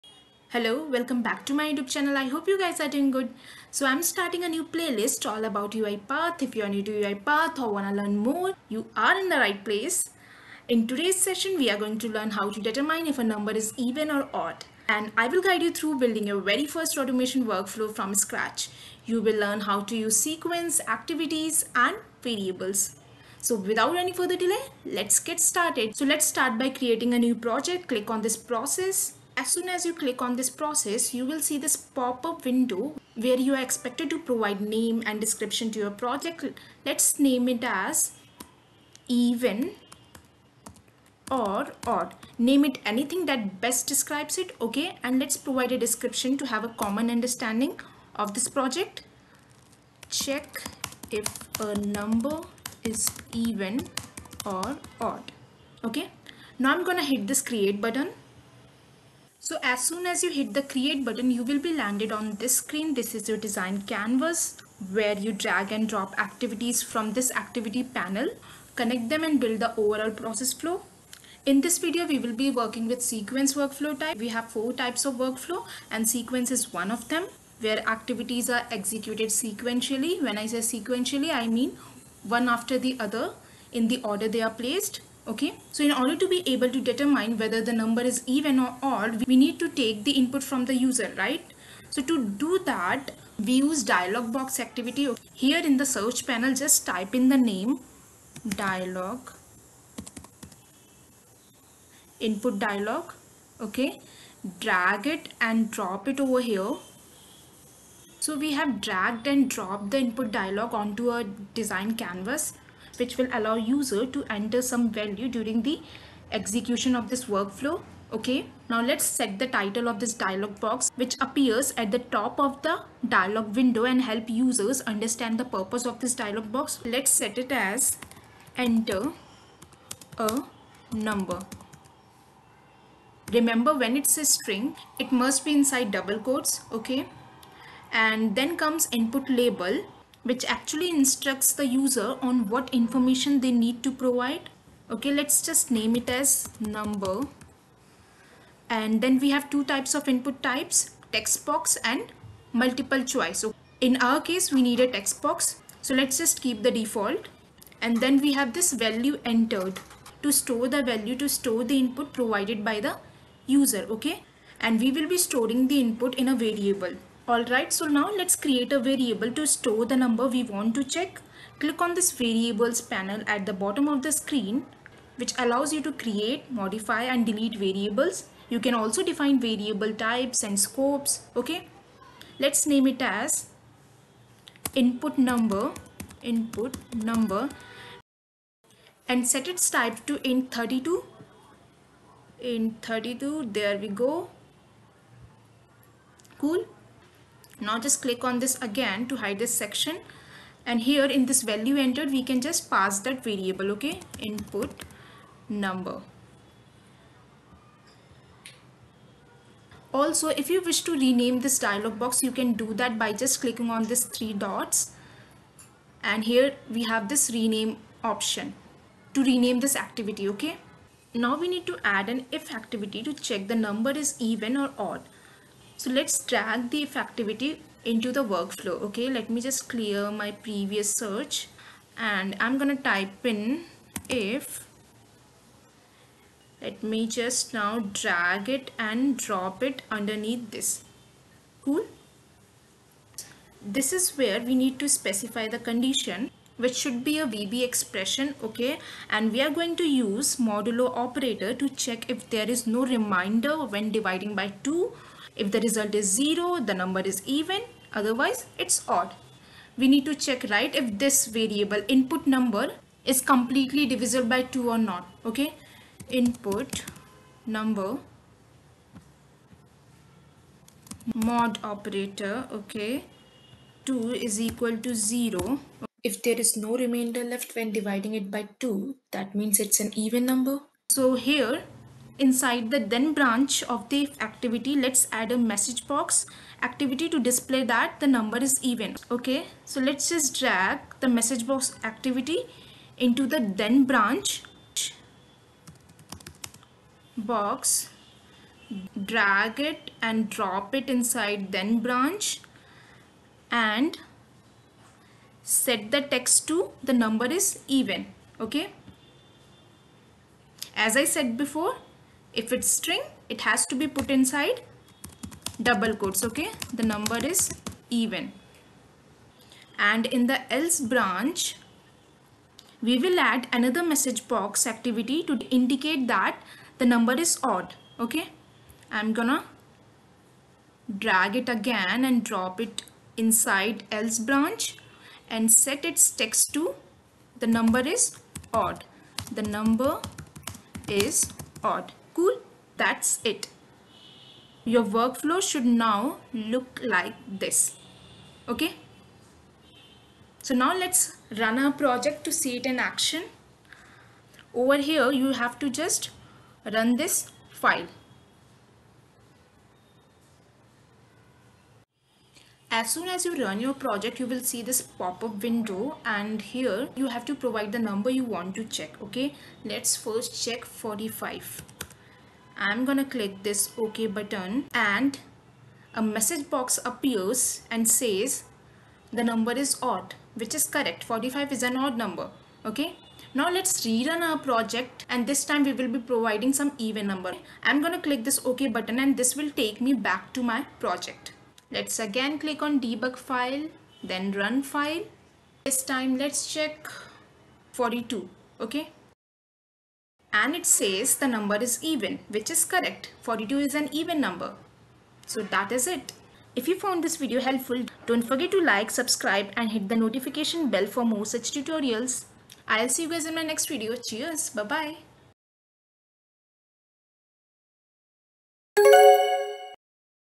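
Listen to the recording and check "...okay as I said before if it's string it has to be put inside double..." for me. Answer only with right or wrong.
right.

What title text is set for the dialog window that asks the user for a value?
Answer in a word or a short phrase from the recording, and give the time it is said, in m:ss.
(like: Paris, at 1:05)
enter a number, at 2:08.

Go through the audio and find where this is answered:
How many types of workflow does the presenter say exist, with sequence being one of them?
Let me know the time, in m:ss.
1:14.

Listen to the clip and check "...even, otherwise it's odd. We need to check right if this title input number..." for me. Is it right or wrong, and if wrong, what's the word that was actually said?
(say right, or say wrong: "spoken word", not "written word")
wrong: "variable", not "title".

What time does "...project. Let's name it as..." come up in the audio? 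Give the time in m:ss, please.
0:35.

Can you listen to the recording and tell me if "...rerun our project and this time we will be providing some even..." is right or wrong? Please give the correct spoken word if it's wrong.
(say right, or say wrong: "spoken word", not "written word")
right.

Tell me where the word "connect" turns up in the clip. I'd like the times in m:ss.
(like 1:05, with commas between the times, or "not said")
1:08.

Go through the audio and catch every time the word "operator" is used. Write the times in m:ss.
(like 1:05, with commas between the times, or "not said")
4:10, 4:31.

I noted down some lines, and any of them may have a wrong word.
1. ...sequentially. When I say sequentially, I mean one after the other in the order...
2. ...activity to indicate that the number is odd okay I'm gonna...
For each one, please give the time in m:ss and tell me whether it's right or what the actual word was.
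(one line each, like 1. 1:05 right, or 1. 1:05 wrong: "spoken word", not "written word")
1. 1:19 right
2. 5:24 right.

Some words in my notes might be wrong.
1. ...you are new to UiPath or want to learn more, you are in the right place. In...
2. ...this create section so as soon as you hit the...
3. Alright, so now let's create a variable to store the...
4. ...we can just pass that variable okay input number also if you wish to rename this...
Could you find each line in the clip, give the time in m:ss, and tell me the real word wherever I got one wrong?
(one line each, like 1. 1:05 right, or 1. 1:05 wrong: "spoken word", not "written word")
1. 0:06 right
2. 0:57 wrong: "button", not "section"
3. 2:47 right
4. 3:22 right.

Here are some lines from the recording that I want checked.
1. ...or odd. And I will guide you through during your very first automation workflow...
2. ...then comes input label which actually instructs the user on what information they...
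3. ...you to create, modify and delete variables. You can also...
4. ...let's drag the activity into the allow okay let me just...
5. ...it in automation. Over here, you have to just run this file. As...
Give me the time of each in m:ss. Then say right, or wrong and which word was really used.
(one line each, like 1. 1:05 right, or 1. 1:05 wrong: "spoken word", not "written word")
1. 0:14 wrong: "building", not "during"
2. 2:18 right
3. 2:55 right
4. 3:45 wrong: "workflow", not "allow"
5. 5:52 wrong: "action", not "automation".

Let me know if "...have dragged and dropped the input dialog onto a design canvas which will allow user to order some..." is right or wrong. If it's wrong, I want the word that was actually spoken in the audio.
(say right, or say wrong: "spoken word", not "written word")
wrong: "enter", not "order".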